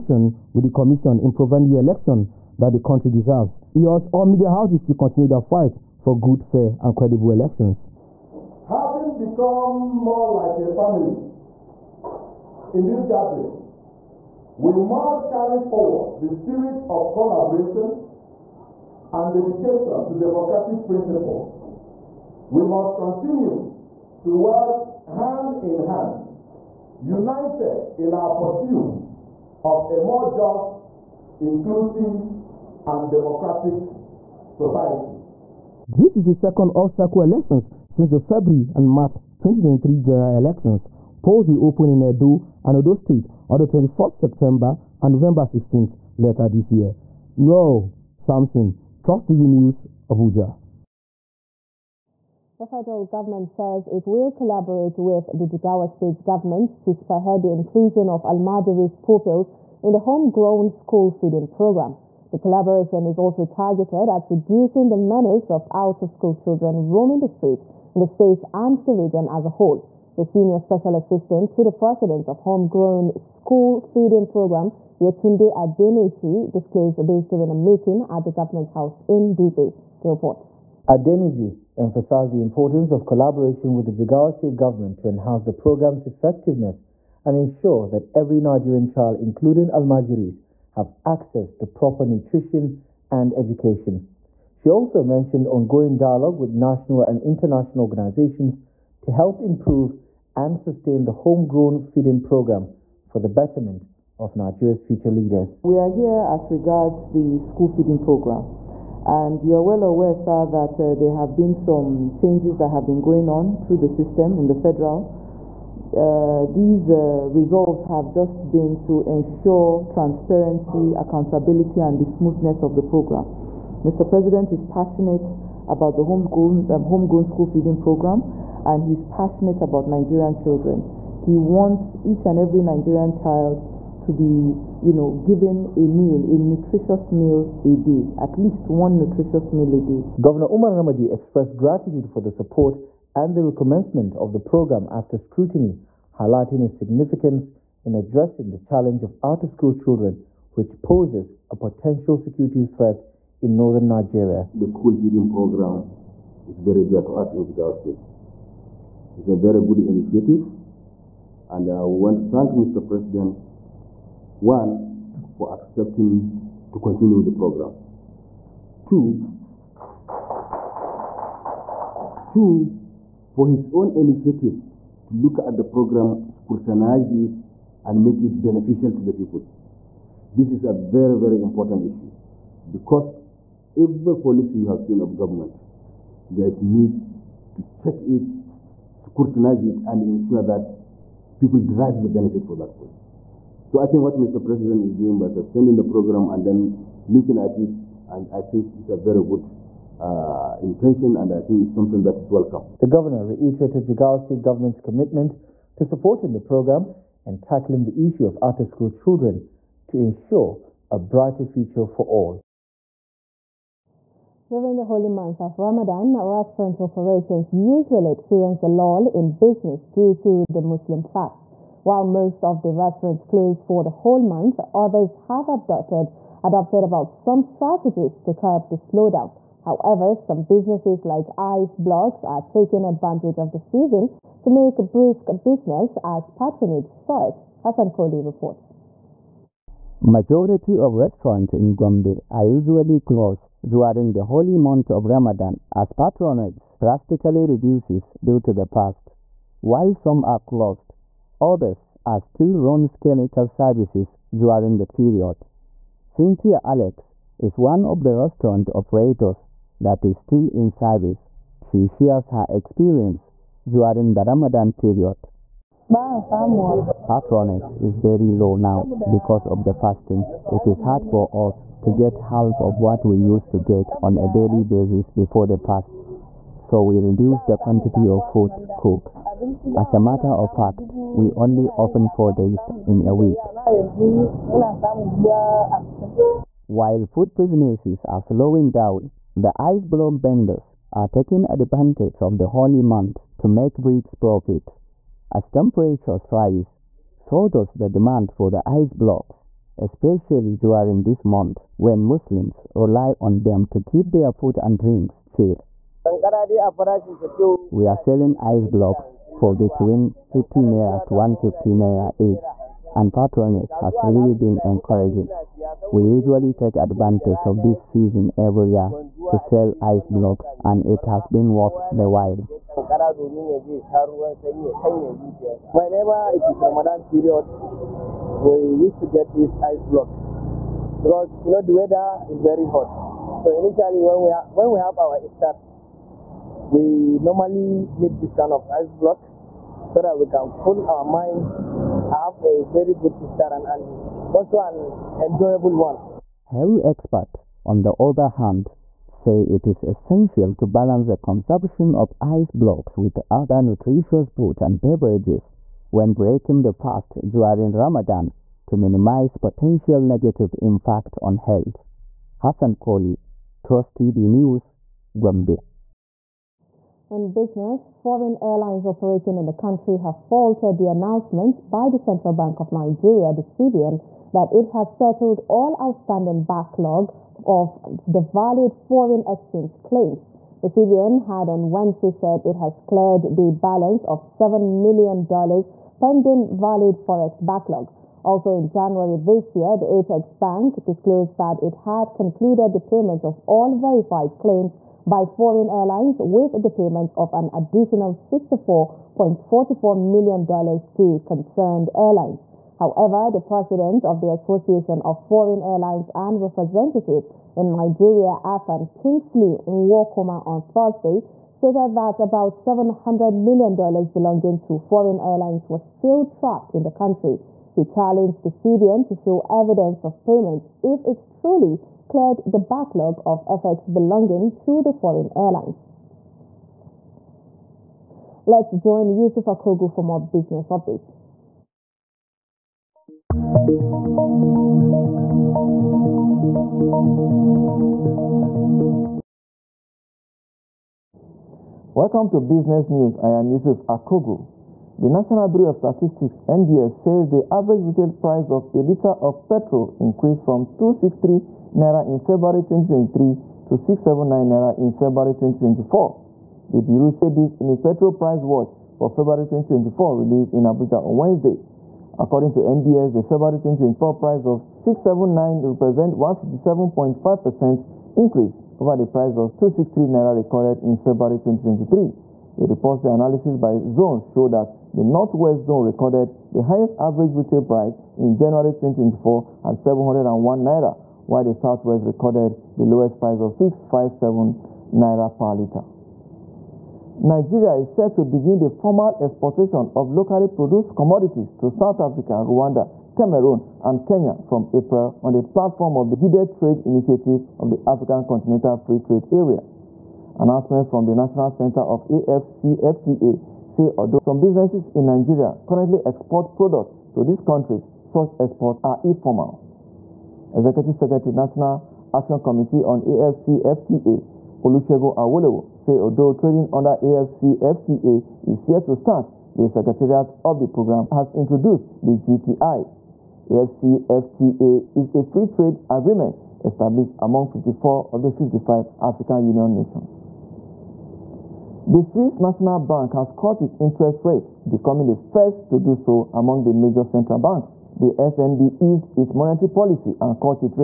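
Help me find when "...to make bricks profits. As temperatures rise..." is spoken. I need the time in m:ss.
4:53.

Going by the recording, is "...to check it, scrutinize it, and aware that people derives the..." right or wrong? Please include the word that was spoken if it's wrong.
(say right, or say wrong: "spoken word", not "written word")
wrong: "ensure", not "aware".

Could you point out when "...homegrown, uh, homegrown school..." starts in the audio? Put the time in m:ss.
2:06.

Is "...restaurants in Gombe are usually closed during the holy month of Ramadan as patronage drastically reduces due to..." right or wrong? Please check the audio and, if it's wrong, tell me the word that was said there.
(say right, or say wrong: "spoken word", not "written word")
right.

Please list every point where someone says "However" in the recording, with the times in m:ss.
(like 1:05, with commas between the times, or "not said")
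3:49, 6:42.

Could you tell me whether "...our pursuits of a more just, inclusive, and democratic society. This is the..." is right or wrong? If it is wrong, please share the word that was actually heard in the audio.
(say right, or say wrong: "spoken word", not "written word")
right.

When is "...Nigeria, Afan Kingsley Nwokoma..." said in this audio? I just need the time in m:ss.
6:47.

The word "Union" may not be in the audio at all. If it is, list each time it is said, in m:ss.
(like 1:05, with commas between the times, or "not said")
8:49.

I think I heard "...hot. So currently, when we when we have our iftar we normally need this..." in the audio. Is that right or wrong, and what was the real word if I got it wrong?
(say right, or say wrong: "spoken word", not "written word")
wrong: "initially", not "currently".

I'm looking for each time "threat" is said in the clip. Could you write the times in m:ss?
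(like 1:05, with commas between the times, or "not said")
2:32.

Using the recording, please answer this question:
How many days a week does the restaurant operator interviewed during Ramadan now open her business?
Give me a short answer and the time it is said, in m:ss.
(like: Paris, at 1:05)
4, at 4:42.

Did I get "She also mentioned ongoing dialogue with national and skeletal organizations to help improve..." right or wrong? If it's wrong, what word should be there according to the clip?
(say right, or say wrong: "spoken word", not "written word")
wrong: "international", not "skeletal".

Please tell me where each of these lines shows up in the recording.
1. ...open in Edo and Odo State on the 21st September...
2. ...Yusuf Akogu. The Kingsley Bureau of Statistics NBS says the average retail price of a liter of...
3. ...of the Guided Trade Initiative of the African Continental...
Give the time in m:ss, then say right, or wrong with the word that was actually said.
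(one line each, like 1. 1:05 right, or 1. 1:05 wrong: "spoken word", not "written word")
1. 0:41 right
2. 7:23 wrong: "National", not "Kingsley"
3. 8:15 right.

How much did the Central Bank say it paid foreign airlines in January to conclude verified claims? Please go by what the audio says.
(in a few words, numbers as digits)
$64.44 million.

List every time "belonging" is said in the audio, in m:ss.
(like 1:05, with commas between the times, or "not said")
6:53, 7:03.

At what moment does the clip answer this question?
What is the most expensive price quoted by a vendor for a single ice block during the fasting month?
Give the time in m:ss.
5:11.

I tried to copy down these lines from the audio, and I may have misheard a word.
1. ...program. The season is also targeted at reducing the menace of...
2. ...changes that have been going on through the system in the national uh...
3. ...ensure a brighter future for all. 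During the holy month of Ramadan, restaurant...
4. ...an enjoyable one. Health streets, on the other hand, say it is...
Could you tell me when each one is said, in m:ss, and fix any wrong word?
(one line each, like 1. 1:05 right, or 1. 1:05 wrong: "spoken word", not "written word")
1. 1:01 wrong: "collaboration", not "season"
2. 1:52 wrong: "federal", not "national"
3. 3:29 right
4. 5:44 wrong: "experts", not "streets".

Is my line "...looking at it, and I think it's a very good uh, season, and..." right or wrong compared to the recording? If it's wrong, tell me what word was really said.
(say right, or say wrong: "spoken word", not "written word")
wrong: "intention", not "season".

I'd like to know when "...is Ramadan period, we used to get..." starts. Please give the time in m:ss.
5:26.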